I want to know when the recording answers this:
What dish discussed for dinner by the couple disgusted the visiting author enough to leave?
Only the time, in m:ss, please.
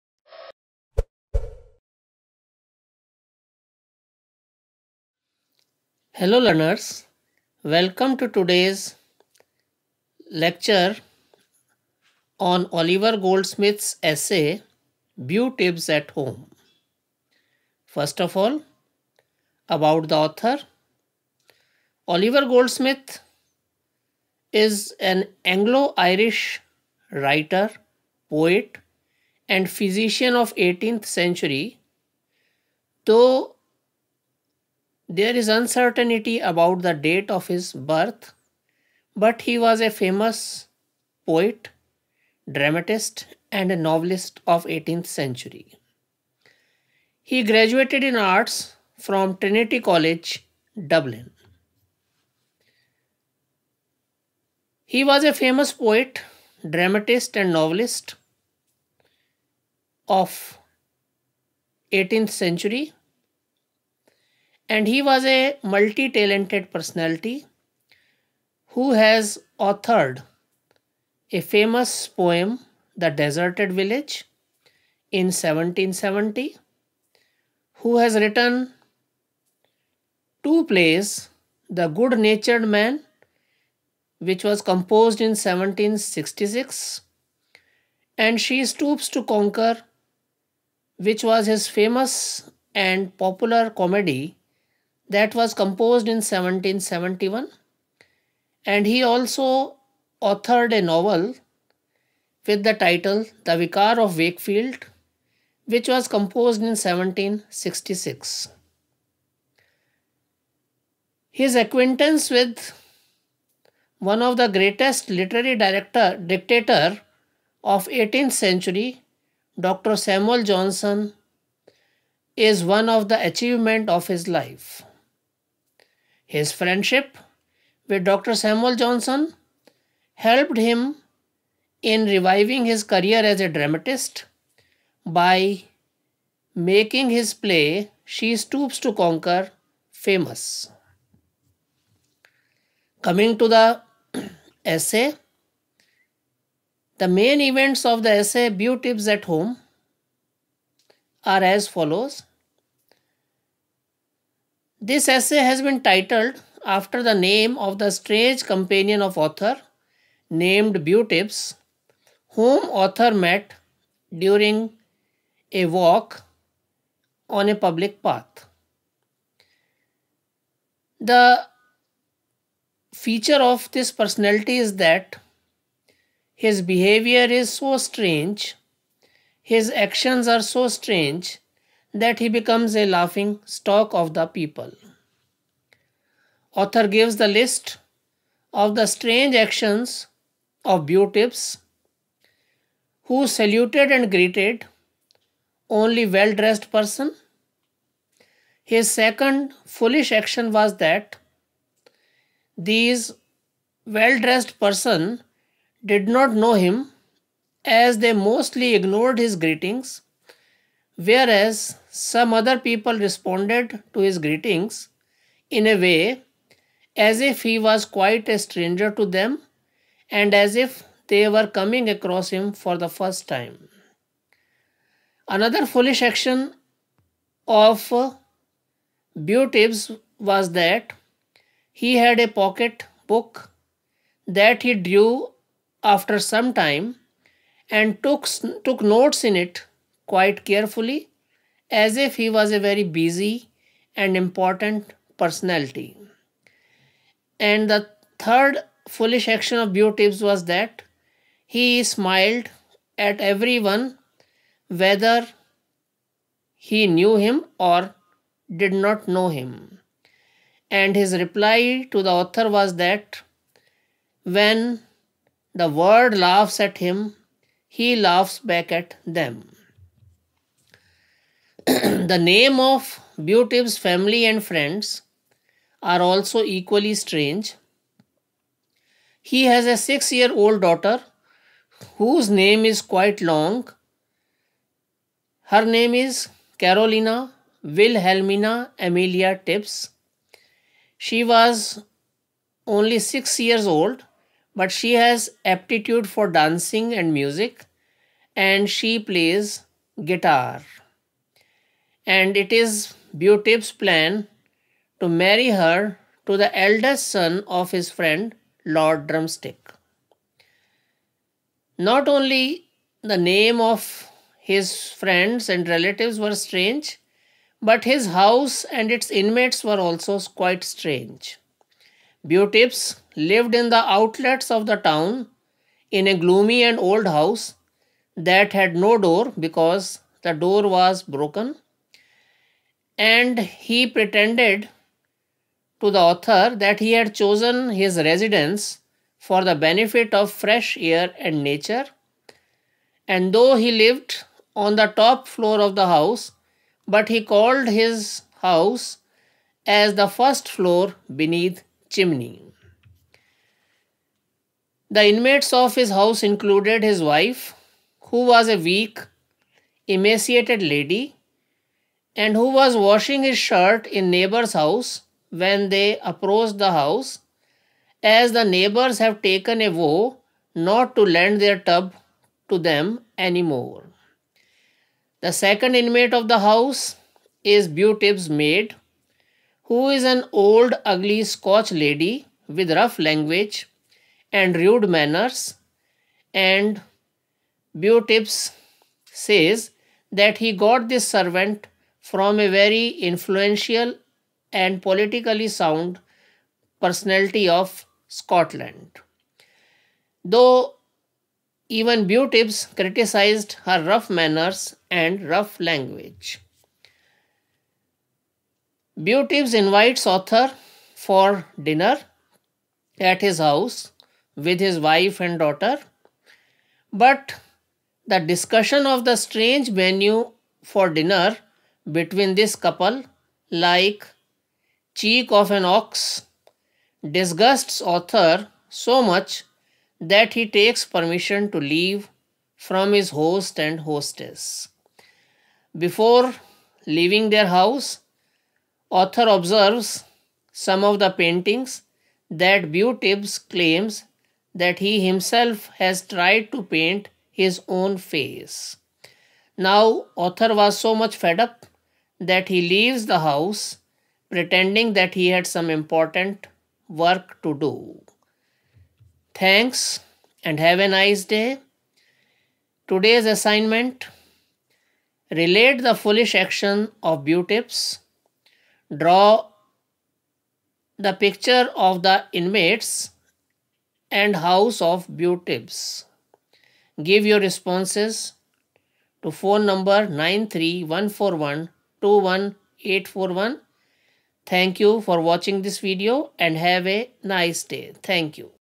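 7:04.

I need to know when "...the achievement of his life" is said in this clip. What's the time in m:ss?
2:03.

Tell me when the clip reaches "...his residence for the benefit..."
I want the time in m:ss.
5:37.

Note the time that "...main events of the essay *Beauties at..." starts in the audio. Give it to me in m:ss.
2:27.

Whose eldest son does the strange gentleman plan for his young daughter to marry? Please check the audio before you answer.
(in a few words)
Lord Drumstick.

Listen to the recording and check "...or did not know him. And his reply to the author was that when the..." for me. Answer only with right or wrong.
right.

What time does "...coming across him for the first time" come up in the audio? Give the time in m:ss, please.
3:41.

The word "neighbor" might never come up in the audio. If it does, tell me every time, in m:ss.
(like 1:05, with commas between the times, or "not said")
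6:04, 6:08.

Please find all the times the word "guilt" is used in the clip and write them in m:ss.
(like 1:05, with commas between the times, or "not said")
not said.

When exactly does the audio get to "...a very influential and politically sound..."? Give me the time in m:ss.
6:32.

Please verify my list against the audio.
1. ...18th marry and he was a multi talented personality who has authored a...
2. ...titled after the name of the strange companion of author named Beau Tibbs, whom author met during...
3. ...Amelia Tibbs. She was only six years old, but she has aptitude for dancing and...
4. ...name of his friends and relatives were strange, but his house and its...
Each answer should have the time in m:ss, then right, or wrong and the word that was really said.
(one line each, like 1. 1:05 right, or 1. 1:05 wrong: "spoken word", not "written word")
1. 1:01 wrong: "century", not "marry"
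2. 2:35 right
3. 4:48 right
4. 5:13 right.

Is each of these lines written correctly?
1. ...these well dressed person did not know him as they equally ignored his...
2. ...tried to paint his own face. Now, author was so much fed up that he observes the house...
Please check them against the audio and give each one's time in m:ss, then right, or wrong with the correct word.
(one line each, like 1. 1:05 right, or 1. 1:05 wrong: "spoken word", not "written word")
1. 3:22 wrong: "mostly", not "equally"
2. 7:26 wrong: "leaves", not "observes".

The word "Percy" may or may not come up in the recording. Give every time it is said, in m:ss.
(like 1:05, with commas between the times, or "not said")
not said.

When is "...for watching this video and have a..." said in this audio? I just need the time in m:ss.
8:05.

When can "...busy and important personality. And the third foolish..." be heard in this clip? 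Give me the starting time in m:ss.
4:02.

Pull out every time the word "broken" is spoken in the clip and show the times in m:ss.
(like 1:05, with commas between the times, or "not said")
5:31.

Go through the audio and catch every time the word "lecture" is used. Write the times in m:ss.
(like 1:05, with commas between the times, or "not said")
0:10.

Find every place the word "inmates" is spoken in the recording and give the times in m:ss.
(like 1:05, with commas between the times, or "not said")
5:19, 5:55, 6:15, 7:52.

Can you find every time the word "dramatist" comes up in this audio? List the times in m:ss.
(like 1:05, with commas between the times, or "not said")
0:42, 0:56, 2:13.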